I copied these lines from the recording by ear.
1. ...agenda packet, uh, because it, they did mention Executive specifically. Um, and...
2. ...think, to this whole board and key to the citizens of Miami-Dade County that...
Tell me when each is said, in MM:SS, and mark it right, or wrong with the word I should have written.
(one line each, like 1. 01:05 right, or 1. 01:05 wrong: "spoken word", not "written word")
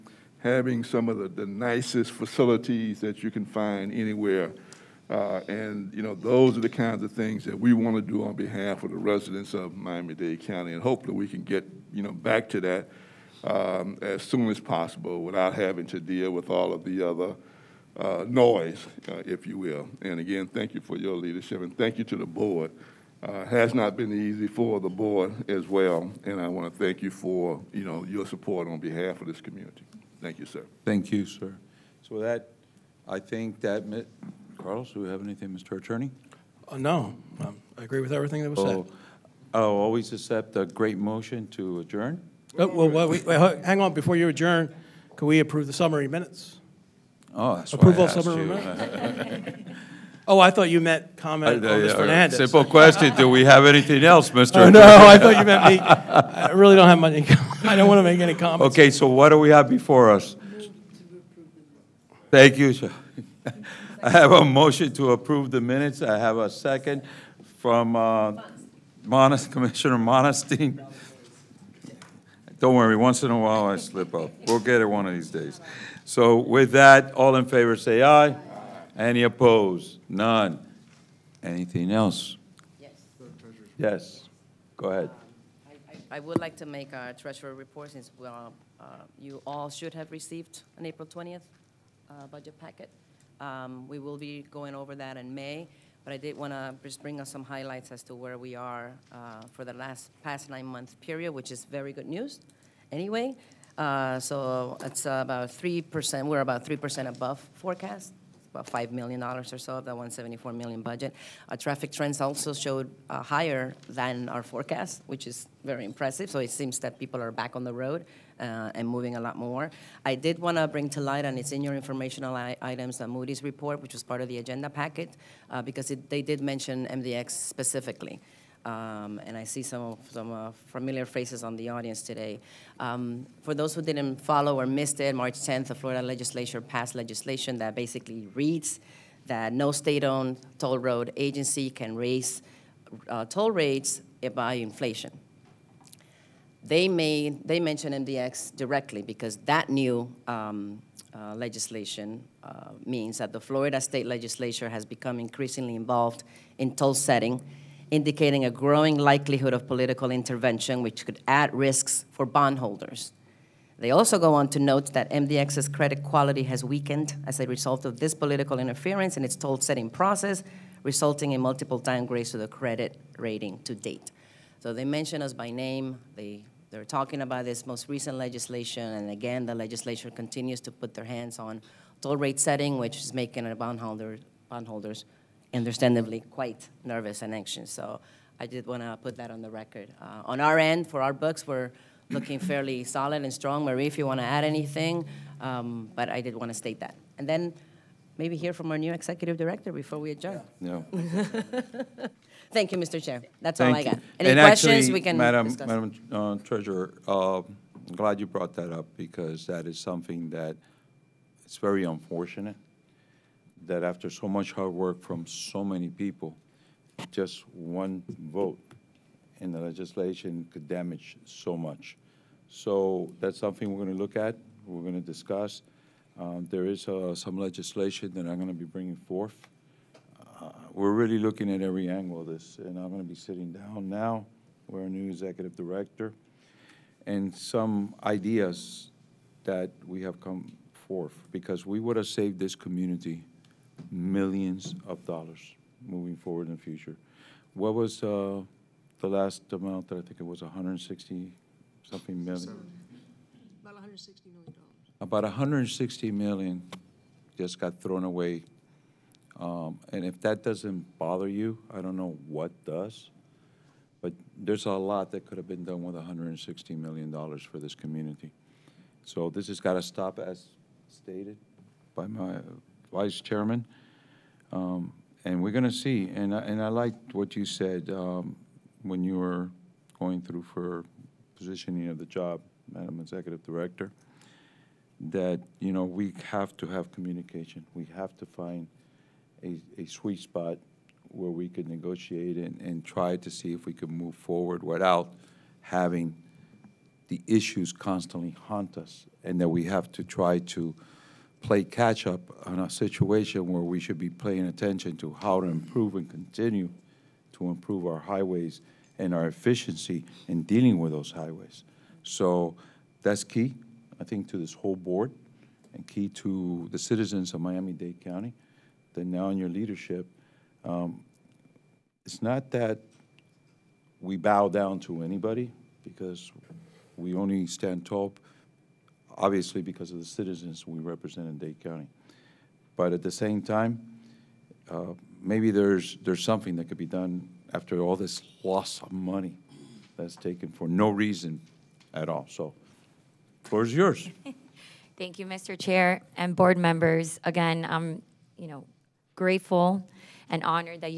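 1. 02:04 wrong: "MDX", not "Executive"
2. 05:14 right.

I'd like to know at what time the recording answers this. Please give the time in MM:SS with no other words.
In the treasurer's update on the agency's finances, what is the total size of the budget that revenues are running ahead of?
01:49.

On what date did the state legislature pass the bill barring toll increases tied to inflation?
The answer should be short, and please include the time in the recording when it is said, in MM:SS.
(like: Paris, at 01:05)
March 10th, at 02:15.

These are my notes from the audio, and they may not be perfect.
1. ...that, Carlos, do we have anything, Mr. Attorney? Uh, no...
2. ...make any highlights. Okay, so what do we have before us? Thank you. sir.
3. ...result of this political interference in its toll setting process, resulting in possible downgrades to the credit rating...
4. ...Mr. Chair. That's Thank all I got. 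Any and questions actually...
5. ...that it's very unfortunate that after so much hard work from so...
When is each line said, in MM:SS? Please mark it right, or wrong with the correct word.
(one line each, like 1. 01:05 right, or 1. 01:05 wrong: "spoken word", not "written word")
1. 00:33 right
2. 00:58 wrong: "comments", not "highlights"
3. 02:47 wrong: "multiple", not "possible"
4. 03:22 right
5. 03:30 right.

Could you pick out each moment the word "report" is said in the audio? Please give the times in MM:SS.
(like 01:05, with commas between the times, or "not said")
01:27, 02:03.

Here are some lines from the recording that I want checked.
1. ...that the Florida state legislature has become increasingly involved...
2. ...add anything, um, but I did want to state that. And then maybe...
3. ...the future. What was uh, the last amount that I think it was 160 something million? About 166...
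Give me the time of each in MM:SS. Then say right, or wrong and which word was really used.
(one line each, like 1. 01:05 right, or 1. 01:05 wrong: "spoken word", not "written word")
1. 02:33 right
2. 03:14 right
3. 04:06 wrong: "160", not "166".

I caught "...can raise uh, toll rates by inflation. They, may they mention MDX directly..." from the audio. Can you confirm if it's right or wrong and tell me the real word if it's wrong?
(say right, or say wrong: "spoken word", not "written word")
right.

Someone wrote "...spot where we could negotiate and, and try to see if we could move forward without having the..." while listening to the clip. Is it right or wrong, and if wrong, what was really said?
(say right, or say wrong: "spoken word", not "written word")
right.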